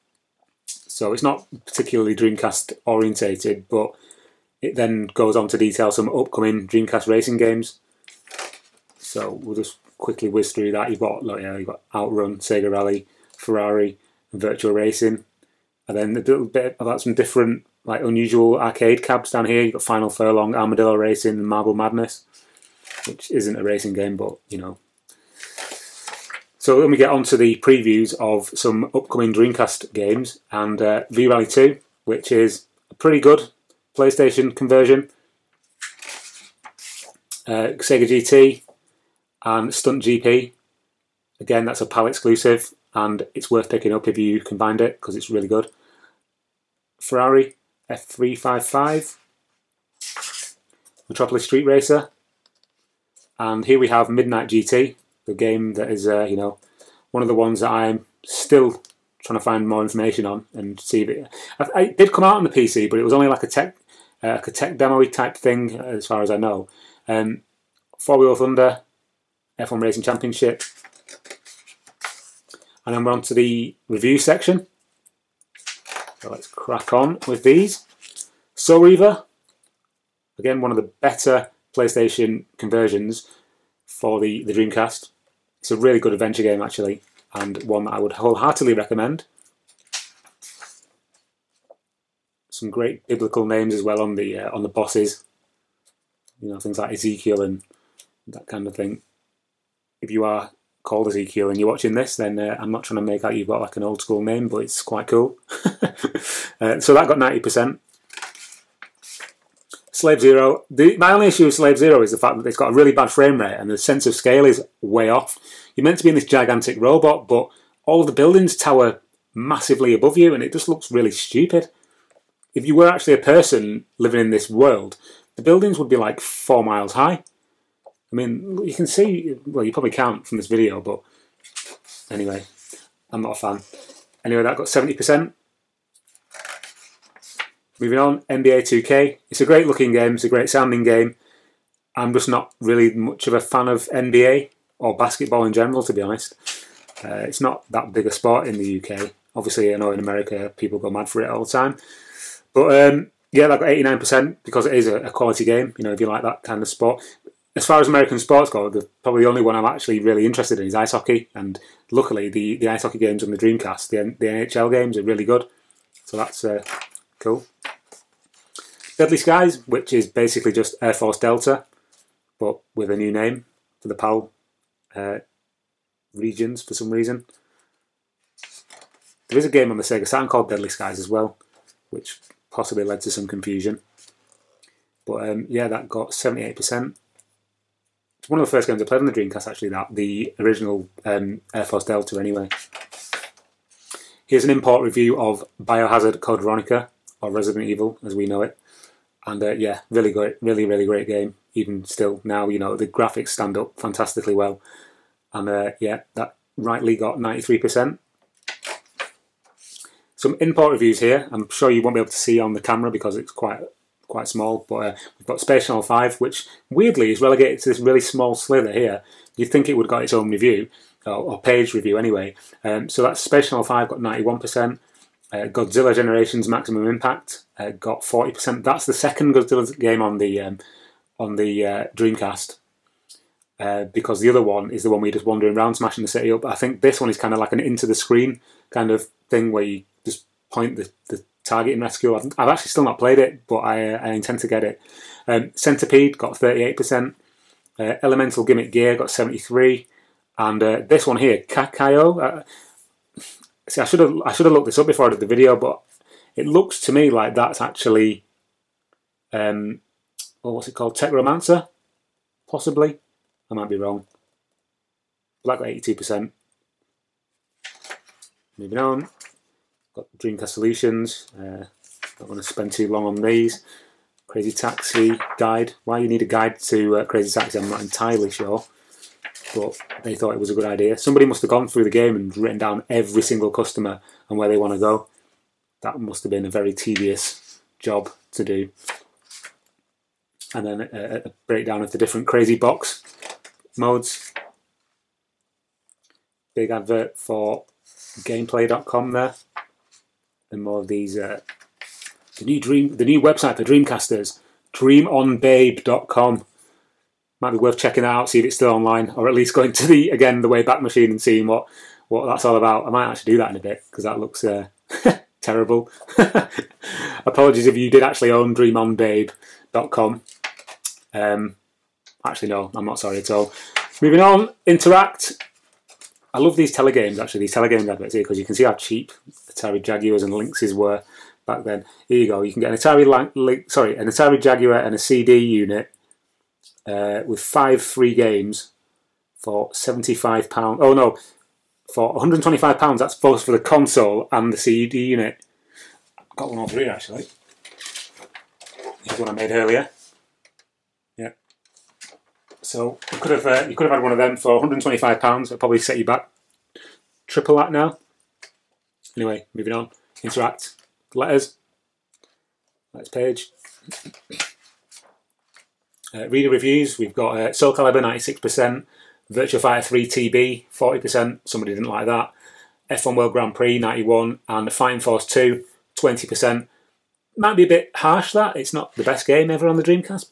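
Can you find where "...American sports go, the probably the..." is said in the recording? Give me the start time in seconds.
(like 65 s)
157 s.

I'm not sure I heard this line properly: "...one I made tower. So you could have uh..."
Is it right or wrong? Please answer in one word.
wrong.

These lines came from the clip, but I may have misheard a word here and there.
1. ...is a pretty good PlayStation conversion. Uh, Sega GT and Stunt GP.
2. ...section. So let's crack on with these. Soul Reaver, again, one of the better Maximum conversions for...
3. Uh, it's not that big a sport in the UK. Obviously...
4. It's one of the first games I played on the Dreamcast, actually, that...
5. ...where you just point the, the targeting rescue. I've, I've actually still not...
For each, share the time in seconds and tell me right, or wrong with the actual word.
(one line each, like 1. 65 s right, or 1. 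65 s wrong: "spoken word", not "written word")
1. 32 s right
2. 74 s wrong: "PlayStation", not "Maximum"
3. 147 s right
4. 188 s right
5. 239 s right.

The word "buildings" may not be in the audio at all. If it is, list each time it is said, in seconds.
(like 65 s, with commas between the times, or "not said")
118 s, 125 s.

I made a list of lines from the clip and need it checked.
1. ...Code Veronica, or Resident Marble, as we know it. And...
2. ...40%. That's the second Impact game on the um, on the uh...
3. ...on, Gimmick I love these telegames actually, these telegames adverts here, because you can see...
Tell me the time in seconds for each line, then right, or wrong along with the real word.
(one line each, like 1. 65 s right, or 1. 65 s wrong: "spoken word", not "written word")
1. 196 s wrong: "Evil", not "Marble"
2. 228 s wrong: "Godzilla", not "Impact"
3. 324 s wrong: "Interact", not "Gimmick".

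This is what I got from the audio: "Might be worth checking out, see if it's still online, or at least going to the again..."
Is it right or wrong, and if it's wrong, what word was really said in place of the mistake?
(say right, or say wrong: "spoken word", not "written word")
right.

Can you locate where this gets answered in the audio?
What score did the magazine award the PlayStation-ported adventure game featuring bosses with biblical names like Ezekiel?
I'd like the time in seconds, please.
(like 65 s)
107 s.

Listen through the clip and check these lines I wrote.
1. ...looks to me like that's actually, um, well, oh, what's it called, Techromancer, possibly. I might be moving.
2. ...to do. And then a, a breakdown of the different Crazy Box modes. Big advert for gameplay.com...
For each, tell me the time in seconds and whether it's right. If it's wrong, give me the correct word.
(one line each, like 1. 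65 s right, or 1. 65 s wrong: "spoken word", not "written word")
1. 256 s wrong: "wrong", not "moving"
2. 288 s right.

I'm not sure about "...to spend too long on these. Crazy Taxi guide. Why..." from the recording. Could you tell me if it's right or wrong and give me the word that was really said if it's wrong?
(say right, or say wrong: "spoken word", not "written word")
right.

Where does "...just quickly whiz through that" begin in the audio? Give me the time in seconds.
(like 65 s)
9 s.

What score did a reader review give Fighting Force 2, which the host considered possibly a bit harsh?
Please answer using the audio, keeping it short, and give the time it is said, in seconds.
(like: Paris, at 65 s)
20%, at 376 s.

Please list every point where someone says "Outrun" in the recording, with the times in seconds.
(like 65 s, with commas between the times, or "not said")
11 s.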